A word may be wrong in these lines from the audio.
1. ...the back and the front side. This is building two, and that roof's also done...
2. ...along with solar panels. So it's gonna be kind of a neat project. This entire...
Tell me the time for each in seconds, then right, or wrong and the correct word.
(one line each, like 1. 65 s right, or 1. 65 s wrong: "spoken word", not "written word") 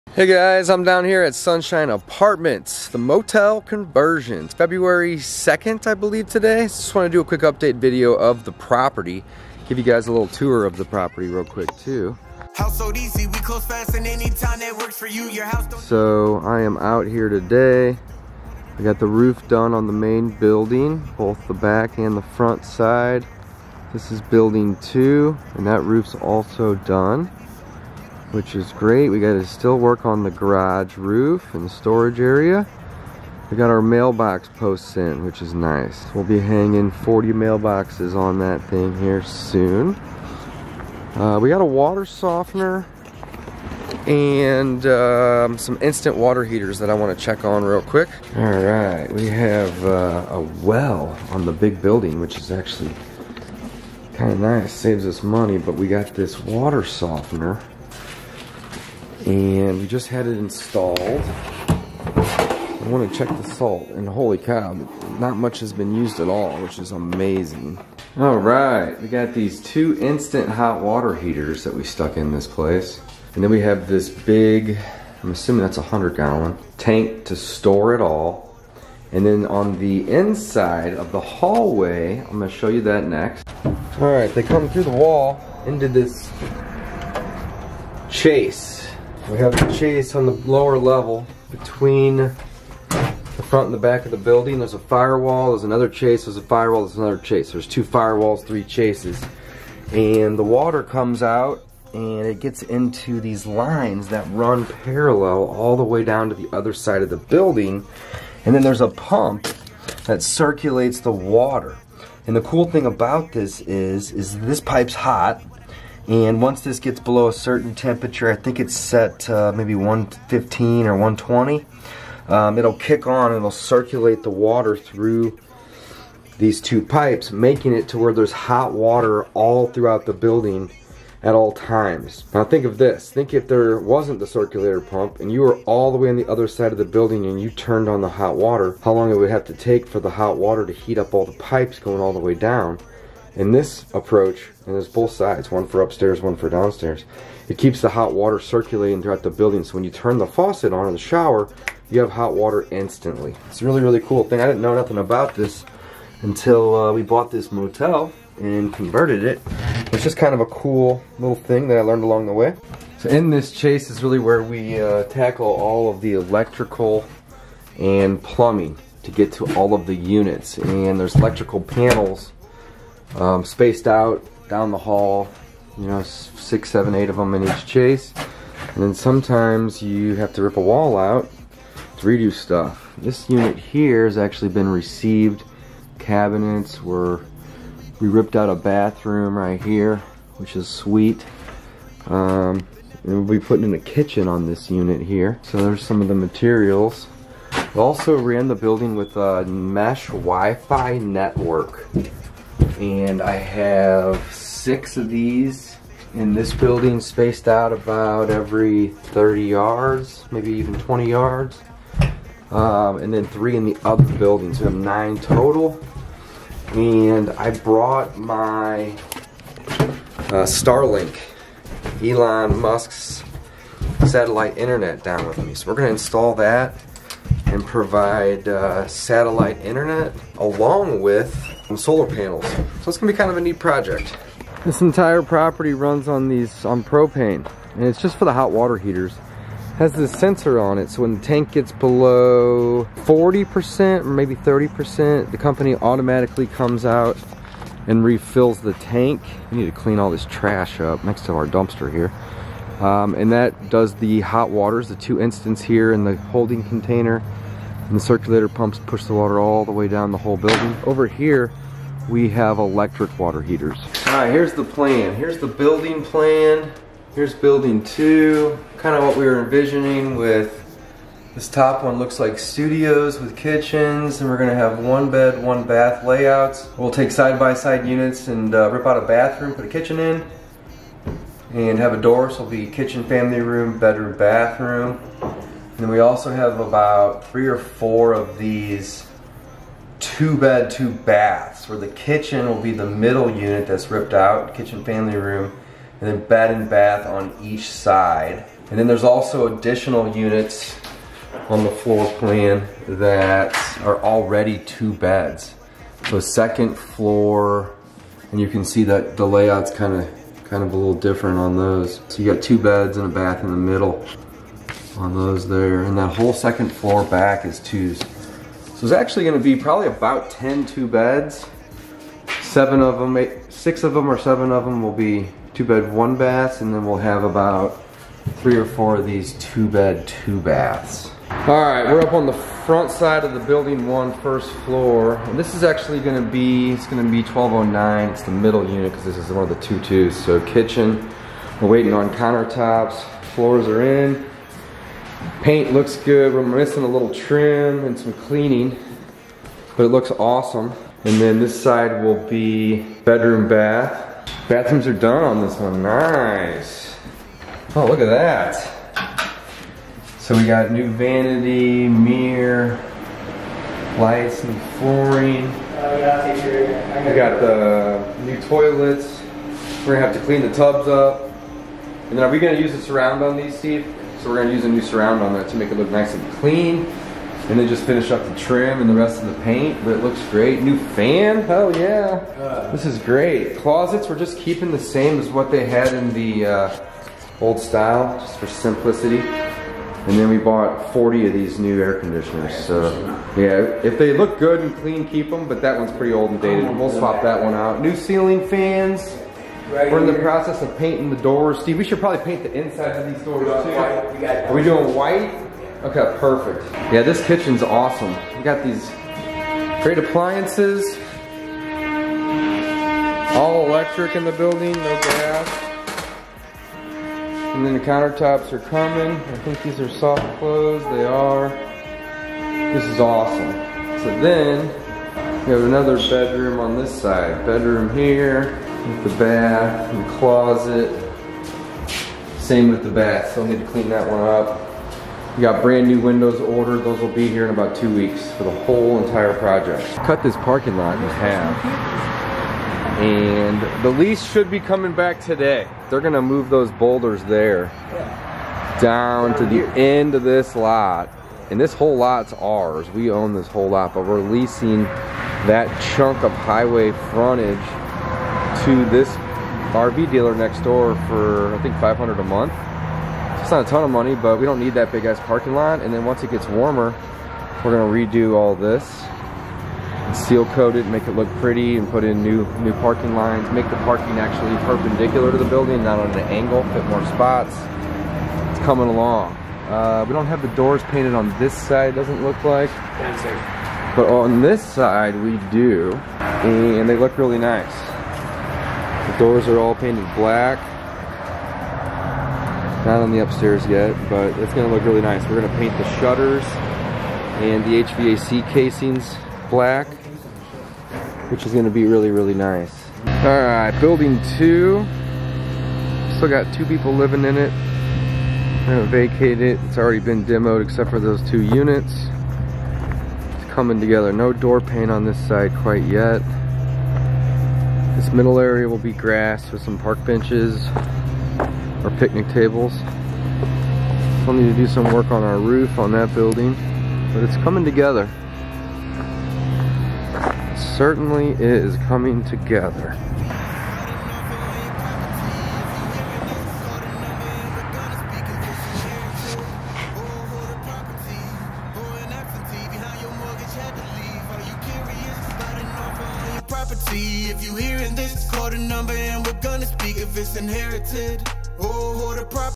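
1. 21 s right
2. 230 s right.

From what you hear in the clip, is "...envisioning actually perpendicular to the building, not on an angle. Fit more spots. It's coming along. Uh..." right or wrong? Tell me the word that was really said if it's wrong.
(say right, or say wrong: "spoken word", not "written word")
wrong: "parking", not "envisioning".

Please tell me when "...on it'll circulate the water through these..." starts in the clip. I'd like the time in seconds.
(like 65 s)
123 s.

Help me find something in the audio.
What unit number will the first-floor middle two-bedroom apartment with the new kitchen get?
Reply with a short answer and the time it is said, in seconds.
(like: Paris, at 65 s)
1209, at 337 s.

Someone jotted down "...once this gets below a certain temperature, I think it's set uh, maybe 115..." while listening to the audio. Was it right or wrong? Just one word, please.
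right.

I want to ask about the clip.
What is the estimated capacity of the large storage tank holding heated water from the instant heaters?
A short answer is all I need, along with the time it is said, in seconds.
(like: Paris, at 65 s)
100 gallon, at 75 s.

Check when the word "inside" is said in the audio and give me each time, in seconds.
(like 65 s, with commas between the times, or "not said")
80 s, 402 s.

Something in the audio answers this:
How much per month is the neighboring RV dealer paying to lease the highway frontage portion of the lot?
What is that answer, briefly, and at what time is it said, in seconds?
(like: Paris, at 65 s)
$500, at 461 s.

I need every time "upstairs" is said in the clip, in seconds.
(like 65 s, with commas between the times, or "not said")
145 s, 493 s.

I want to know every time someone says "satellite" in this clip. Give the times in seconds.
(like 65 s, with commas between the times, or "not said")
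224 s, 228 s.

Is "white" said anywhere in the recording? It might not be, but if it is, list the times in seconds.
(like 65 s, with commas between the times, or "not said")
404 s.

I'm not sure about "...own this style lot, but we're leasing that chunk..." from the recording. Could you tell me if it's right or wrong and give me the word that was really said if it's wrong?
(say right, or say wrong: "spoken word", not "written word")
wrong: "whole", not "style".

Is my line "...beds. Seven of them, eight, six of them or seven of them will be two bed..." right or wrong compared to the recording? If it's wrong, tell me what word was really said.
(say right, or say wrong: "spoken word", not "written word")
right.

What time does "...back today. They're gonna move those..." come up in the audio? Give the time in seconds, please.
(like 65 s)
444 s.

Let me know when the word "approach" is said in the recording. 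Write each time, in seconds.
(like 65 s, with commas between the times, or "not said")
143 s.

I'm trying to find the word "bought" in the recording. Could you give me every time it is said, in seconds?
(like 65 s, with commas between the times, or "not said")
157 s, 390 s.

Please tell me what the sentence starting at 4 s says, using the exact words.
It's February 2nd, I believe, today.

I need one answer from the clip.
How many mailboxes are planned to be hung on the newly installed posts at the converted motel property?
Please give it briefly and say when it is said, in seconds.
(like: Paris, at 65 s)
40, at 36 s.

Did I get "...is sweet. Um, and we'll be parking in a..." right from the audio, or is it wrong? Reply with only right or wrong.
wrong.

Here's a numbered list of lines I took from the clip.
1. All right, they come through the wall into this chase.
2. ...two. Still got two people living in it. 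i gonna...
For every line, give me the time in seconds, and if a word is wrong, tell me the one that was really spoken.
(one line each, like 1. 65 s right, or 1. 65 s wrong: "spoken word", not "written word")
1. 83 s right
2. 504 s right.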